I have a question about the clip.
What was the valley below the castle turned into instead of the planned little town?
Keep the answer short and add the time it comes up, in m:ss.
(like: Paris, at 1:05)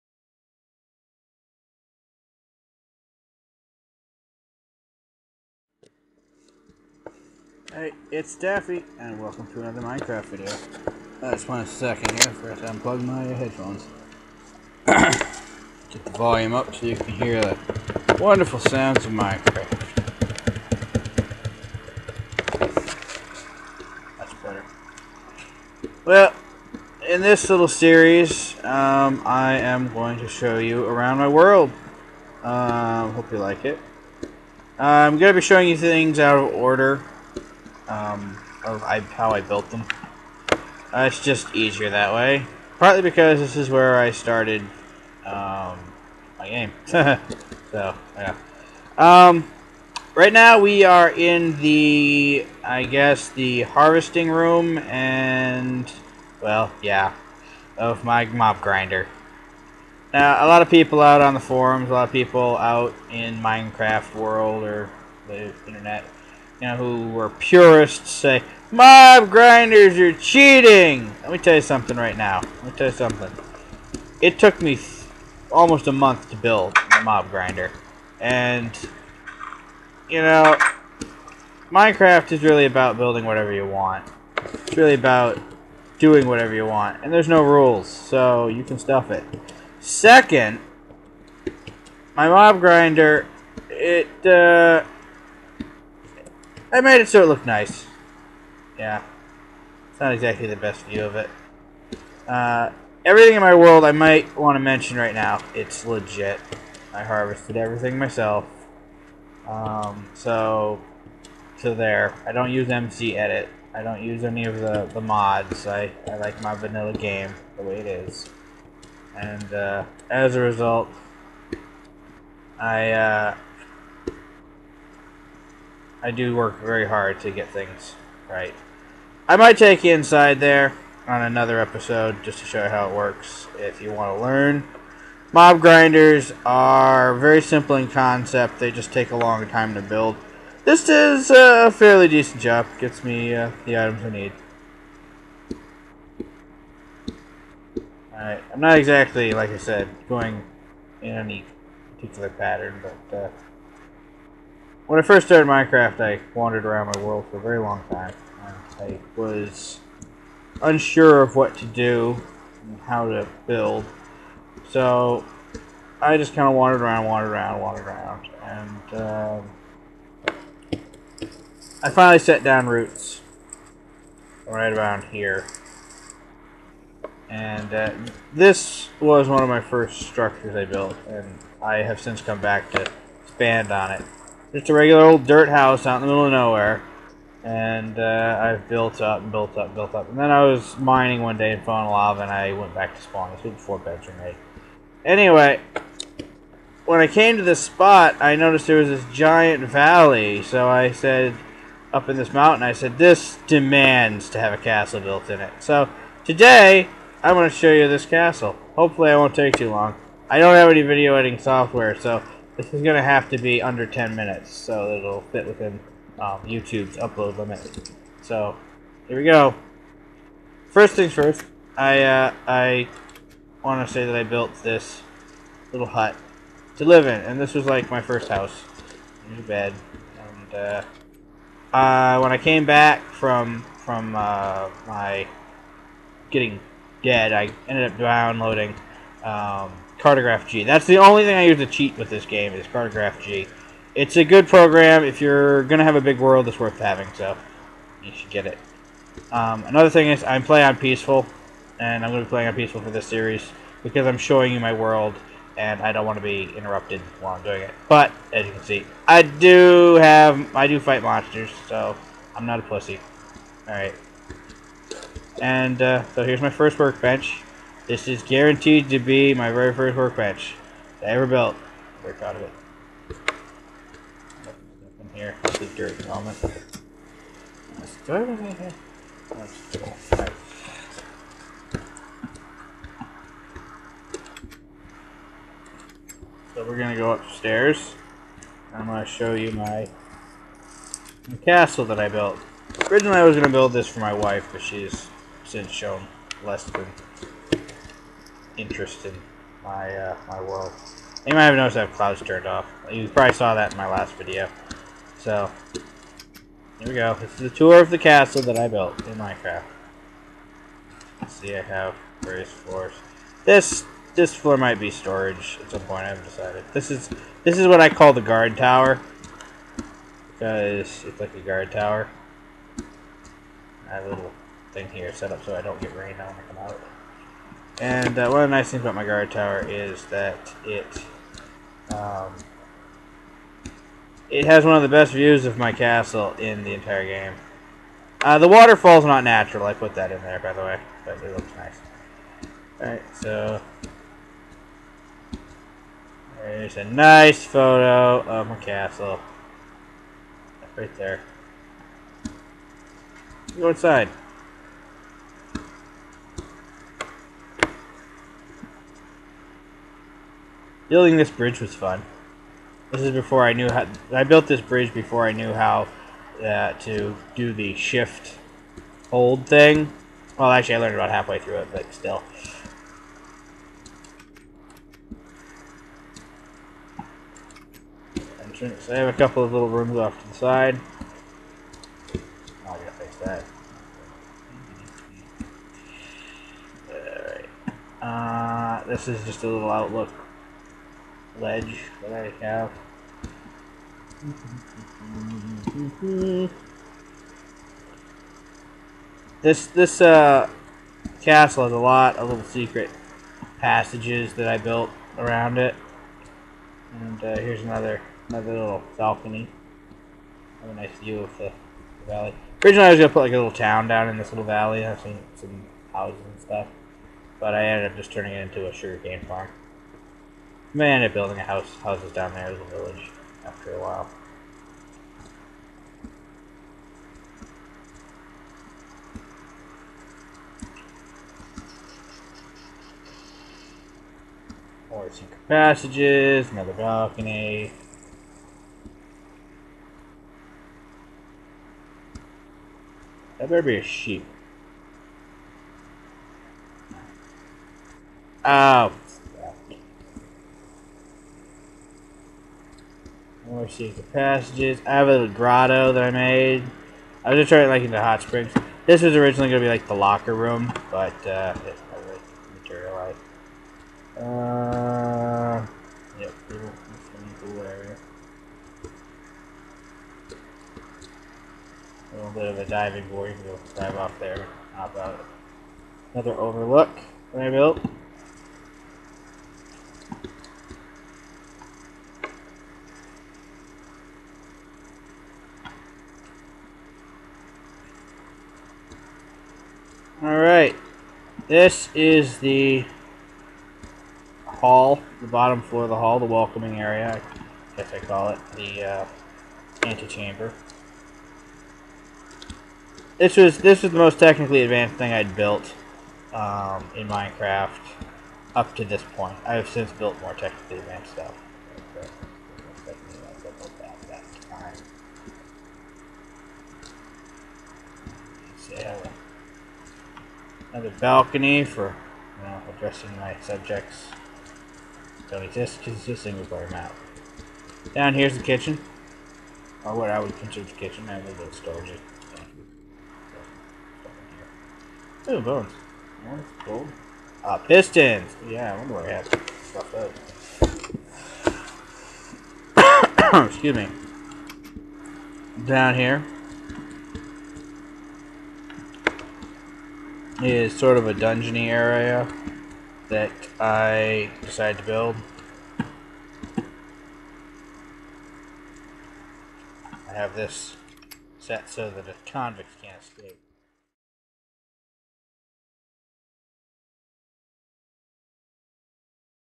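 sugarcane farm, at 6:58.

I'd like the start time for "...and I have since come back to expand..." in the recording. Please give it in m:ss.
3:01.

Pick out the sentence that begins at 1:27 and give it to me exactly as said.
And there's no rules, so you can stuff it.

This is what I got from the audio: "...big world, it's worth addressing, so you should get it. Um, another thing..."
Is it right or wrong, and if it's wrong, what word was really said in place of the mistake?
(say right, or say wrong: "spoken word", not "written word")
wrong: "having", not "addressing".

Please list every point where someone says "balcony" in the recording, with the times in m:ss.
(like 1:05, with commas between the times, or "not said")
6:48, 7:16, 8:41.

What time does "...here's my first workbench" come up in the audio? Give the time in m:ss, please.
4:26.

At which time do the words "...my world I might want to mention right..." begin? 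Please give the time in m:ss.
1:43.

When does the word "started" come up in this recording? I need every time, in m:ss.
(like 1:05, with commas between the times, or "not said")
0:44, 2:35.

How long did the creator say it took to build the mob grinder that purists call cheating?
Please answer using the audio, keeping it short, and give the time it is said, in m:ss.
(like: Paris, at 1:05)
almost a month, at 1:15.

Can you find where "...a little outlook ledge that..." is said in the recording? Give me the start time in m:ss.
6:29.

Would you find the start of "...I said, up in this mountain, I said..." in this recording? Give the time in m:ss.
3:20.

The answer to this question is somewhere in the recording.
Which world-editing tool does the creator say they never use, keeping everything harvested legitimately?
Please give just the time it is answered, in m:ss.
1:52.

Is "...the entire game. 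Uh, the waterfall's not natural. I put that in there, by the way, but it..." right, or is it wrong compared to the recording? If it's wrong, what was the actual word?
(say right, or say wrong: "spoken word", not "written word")
right.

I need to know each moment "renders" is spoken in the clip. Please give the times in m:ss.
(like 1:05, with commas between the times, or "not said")
not said.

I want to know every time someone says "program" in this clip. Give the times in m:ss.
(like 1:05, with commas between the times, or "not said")
4:04.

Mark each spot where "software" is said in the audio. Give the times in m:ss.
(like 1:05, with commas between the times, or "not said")
3:31.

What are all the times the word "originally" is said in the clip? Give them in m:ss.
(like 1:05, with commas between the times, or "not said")
4:52, 6:52, 7:39.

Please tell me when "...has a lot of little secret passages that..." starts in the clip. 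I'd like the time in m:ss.
6:41.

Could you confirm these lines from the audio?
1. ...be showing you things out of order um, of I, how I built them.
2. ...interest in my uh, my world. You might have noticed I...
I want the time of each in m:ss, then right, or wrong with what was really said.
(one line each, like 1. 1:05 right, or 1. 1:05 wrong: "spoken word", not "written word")
1. 0:35 right
2. 4:58 right.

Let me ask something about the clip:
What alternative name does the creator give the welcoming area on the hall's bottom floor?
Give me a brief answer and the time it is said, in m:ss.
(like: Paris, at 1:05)
antechamber, at 8:19.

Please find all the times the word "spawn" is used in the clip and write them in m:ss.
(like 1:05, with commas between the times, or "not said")
3:13.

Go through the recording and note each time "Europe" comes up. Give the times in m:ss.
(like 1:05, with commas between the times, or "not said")
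not said.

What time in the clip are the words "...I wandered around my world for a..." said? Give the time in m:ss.
2:35.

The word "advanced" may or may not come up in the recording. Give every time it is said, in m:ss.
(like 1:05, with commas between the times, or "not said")
8:24, 8:30.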